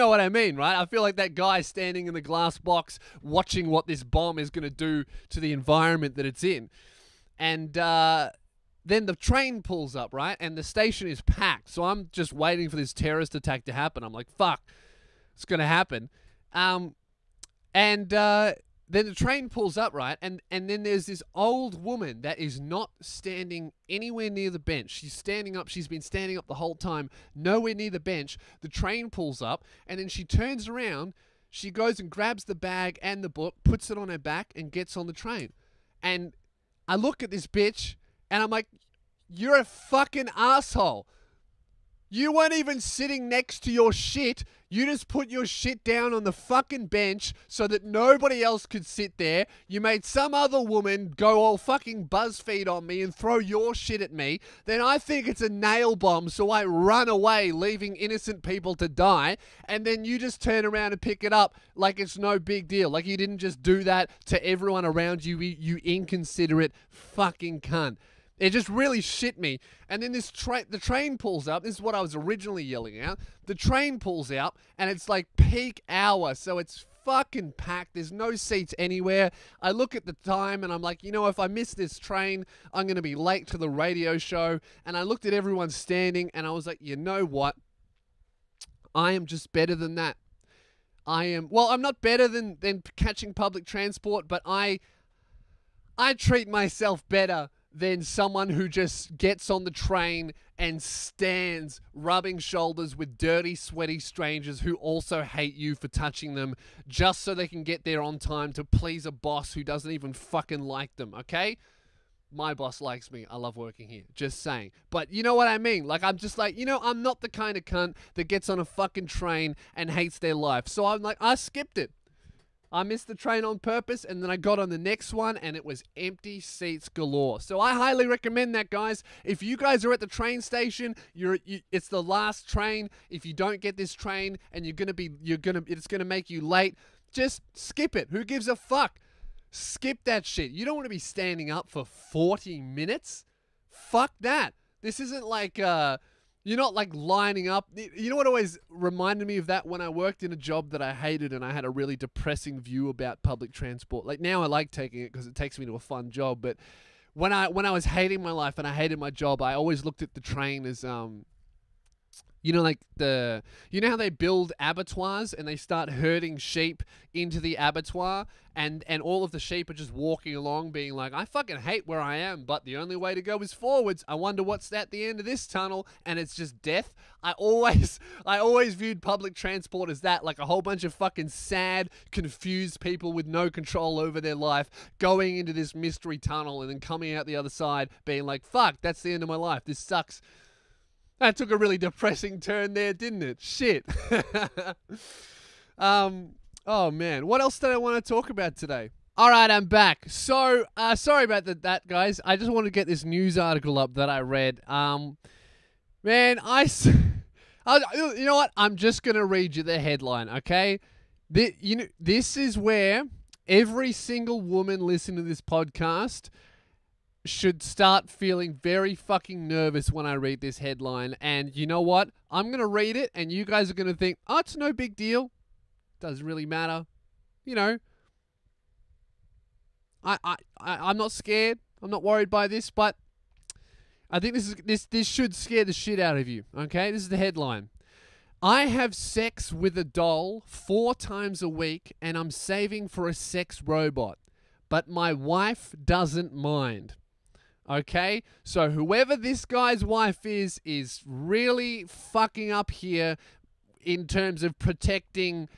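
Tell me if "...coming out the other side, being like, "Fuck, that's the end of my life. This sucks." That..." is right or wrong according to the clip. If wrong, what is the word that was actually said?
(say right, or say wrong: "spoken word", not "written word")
right.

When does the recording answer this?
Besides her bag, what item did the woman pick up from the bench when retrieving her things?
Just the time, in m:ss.
0:33.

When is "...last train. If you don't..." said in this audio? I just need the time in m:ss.
2:12.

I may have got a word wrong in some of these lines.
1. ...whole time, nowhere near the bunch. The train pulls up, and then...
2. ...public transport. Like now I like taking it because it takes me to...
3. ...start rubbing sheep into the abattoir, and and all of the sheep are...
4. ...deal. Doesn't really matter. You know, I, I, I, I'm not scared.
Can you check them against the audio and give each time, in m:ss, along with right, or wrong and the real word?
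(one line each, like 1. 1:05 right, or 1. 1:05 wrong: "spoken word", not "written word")
1. 0:26 wrong: "bench", not "bunch"
2. 2:33 right
3. 2:45 wrong: "herding", not "rubbing"
4. 3:44 right.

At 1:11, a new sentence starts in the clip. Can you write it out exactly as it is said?
This is what I was originally yelling out.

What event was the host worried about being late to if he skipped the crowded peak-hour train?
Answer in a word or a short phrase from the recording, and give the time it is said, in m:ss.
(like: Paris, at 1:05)
The radio show, at 1:23.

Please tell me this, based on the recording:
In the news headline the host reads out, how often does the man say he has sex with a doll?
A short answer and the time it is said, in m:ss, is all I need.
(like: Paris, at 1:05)
4 times a week, at 4:00.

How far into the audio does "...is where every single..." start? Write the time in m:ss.
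3:32.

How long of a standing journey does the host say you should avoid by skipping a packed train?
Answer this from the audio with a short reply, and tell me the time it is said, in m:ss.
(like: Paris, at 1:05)
40 minutes, at 2:21.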